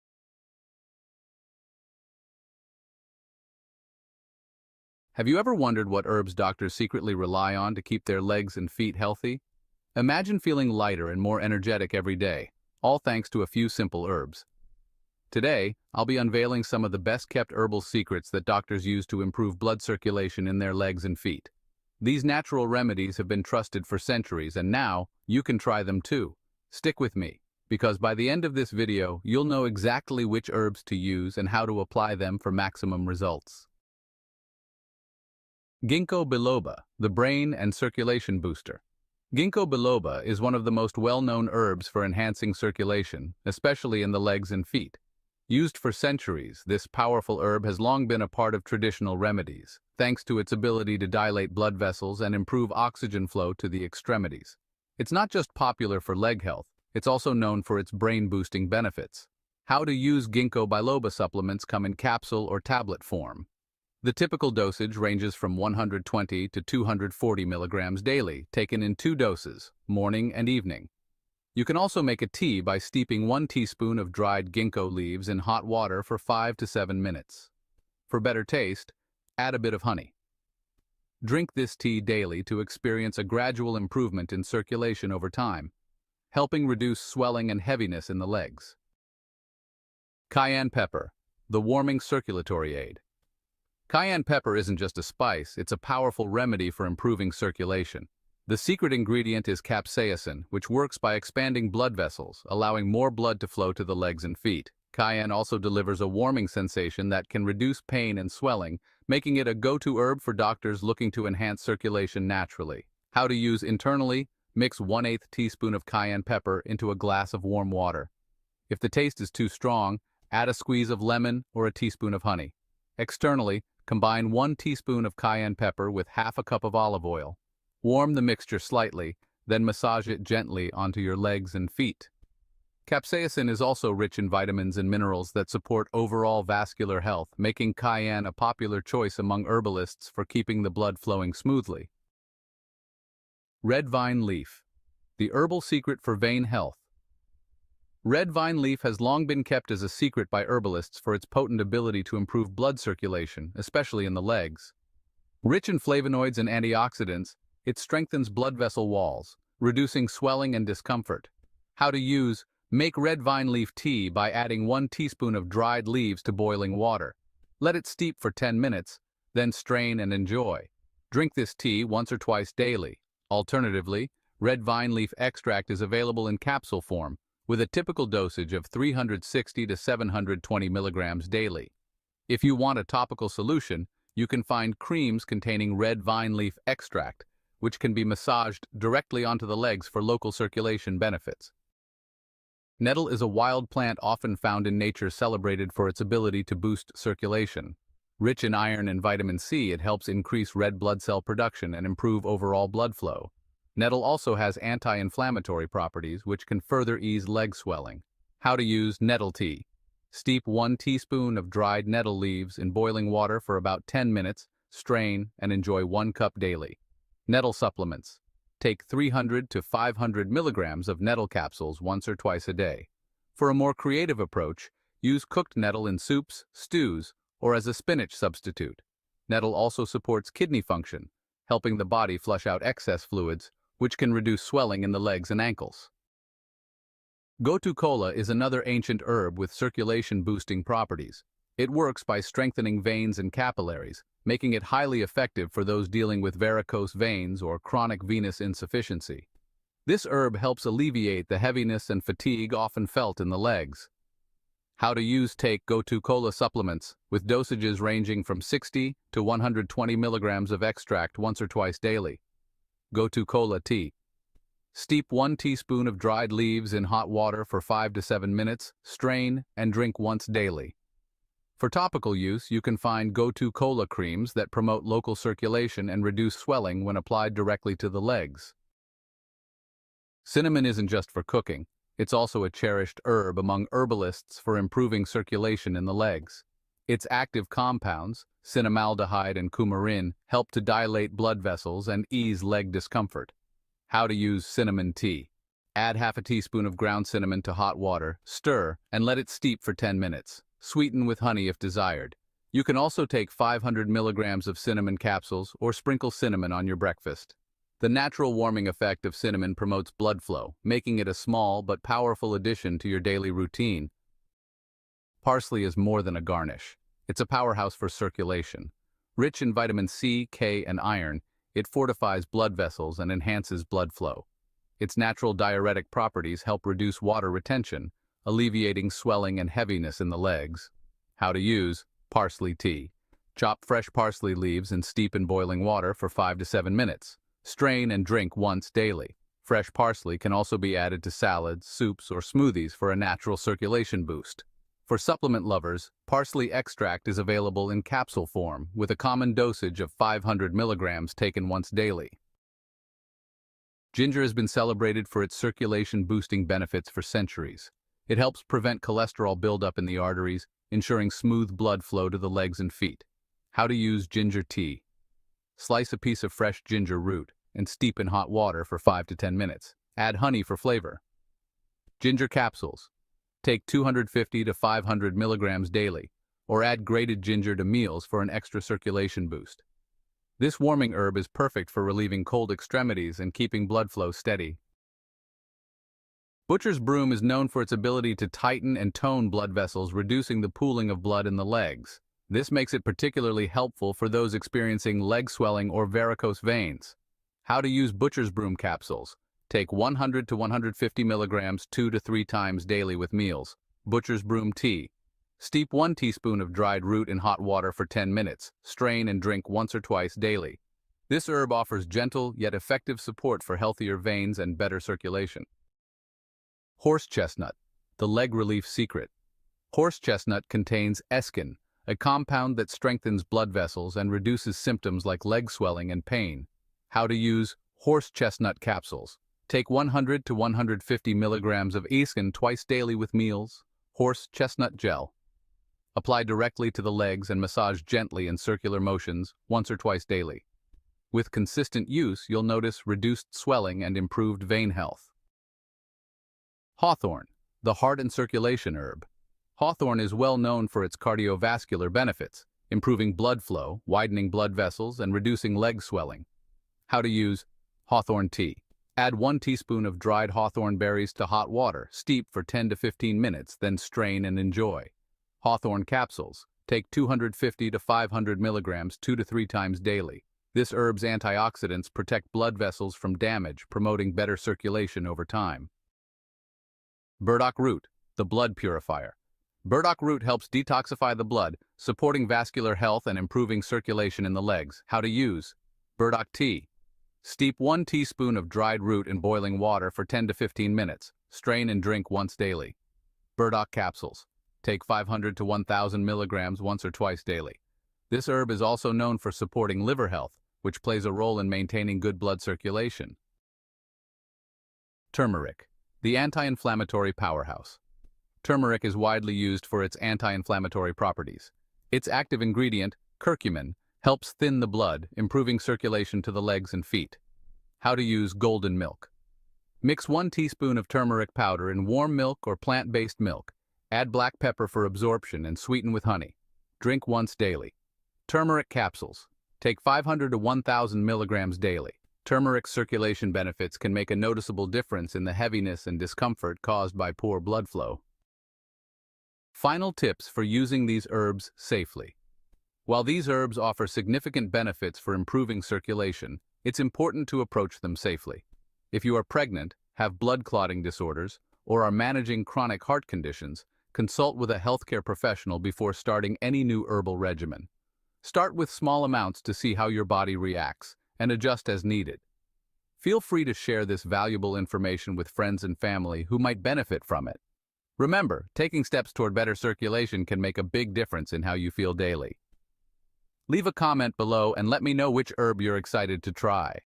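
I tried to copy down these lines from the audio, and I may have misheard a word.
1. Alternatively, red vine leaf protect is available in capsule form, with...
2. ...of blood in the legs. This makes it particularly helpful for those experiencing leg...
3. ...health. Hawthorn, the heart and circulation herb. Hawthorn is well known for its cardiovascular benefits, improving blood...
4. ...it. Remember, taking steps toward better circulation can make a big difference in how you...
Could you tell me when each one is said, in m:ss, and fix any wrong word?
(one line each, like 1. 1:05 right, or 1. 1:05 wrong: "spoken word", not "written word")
1. 2:53 wrong: "extract", not "protect"
2. 6:30 right
3. 7:24 right
4. 9:27 right.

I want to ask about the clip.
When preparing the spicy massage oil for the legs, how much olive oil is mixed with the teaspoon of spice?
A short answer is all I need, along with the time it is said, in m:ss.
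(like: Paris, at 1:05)
Half a cup, at 2:06.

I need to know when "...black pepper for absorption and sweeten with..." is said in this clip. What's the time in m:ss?
8:44.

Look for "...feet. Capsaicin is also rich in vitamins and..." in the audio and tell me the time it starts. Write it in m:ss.
2:11.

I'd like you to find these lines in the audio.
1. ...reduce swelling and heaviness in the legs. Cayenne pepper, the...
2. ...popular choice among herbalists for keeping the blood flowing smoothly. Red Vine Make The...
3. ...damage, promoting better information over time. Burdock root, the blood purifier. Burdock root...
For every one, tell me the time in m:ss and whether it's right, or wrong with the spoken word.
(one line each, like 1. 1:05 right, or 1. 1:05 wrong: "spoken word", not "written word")
1. 1:26 right
2. 2:18 wrong: "Leaf", not "Make"
3. 7:53 wrong: "circulation", not "information".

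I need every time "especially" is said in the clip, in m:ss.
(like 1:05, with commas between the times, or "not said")
0:43, 2:33.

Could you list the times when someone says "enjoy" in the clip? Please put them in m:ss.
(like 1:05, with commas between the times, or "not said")
2:50, 3:35, 7:44.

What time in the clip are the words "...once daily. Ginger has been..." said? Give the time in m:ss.
5:51.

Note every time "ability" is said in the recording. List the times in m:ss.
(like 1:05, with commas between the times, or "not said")
0:50, 2:31, 3:16, 6:27.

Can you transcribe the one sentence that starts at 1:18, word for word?
For better taste, add a bit of honey.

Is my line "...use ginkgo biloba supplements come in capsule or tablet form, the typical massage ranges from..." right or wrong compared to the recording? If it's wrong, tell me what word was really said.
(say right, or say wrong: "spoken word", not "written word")
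wrong: "dosage", not "massage".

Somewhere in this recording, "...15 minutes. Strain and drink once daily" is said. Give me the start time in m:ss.
8:10.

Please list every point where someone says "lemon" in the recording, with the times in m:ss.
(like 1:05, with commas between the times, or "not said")
2:01.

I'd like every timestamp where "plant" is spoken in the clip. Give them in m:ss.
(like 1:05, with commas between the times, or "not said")
3:13, 8:42.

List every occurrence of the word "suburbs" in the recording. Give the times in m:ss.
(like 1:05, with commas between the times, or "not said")
not said.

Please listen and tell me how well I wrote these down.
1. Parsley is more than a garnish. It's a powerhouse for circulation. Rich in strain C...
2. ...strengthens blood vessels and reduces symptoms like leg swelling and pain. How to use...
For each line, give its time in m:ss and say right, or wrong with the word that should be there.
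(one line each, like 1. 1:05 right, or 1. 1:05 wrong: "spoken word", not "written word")
1. 5:15 wrong: "vitamin", not "strain"
2. 7:02 right.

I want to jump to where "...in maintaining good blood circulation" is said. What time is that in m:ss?
8:21.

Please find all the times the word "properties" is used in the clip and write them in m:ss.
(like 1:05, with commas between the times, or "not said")
3:25, 4:00, 5:25, 8:30.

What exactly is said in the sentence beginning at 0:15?
Today, I'll be unveiling some of the best-kept herbal secrets that doctors use to improve blood circulation in their legs and feet.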